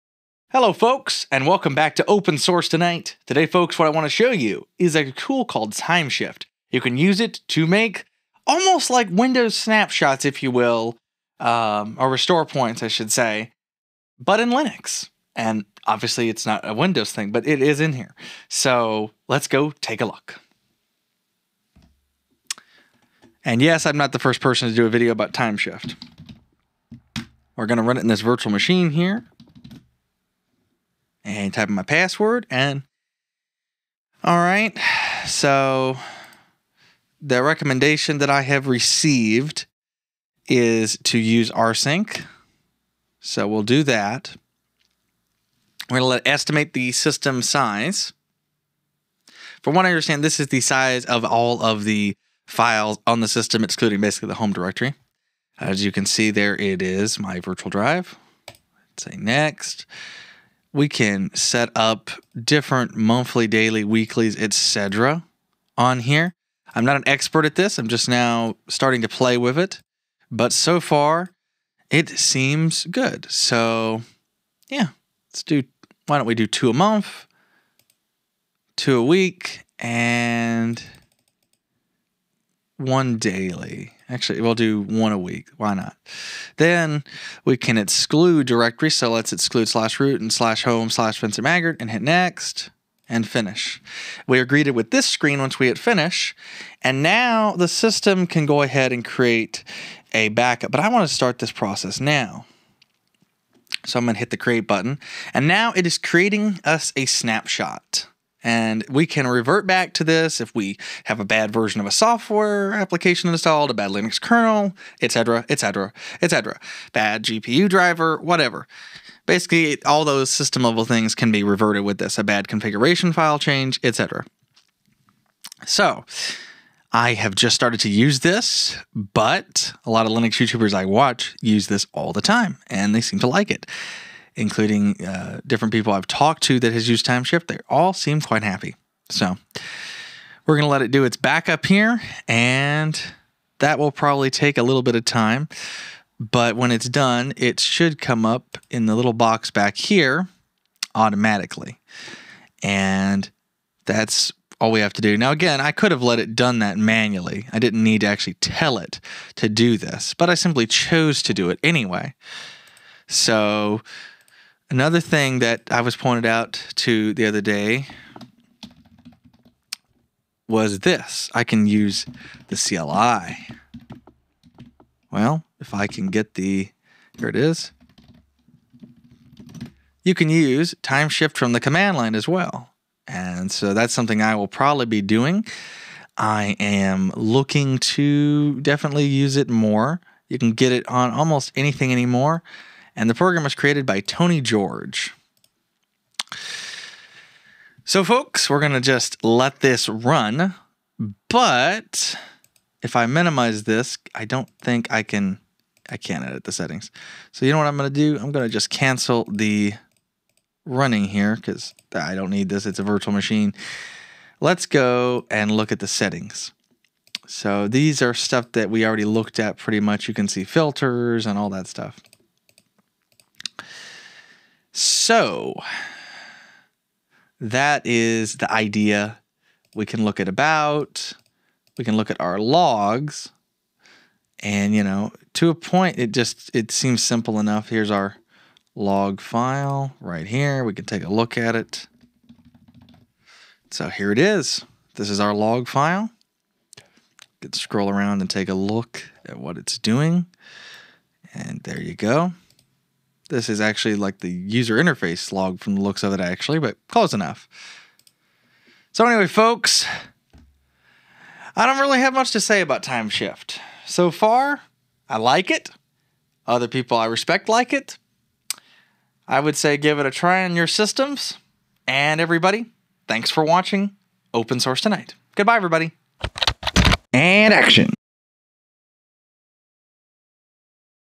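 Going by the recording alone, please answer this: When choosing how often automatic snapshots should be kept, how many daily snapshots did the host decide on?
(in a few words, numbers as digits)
1.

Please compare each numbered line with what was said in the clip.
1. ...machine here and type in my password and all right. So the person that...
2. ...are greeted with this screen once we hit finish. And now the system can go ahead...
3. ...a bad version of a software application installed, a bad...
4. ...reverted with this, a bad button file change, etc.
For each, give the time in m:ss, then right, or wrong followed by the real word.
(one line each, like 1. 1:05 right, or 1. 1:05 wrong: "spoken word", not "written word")
1. 0:28 wrong: "recommendation", not "person"
2. 1:34 right
3. 1:51 right
4. 2:01 wrong: "configuration", not "button".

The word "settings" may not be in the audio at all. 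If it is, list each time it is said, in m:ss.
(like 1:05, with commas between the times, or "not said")
3:26, 3:35.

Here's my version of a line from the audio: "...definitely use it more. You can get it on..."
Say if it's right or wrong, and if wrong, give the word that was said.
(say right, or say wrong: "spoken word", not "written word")
right.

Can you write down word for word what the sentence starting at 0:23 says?
And yes, I'm not the first person to do a video about Timeshift.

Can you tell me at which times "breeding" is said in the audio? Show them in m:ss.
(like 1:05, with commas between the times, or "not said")
not said.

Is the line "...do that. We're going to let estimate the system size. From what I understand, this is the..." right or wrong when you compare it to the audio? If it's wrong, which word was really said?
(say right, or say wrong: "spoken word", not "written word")
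right.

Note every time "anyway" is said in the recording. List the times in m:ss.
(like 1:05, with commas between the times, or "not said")
2:41, 4:19.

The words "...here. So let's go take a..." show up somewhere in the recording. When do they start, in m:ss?
0:17.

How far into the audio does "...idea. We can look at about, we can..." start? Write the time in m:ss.
3:48.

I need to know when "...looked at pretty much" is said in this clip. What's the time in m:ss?
3:39.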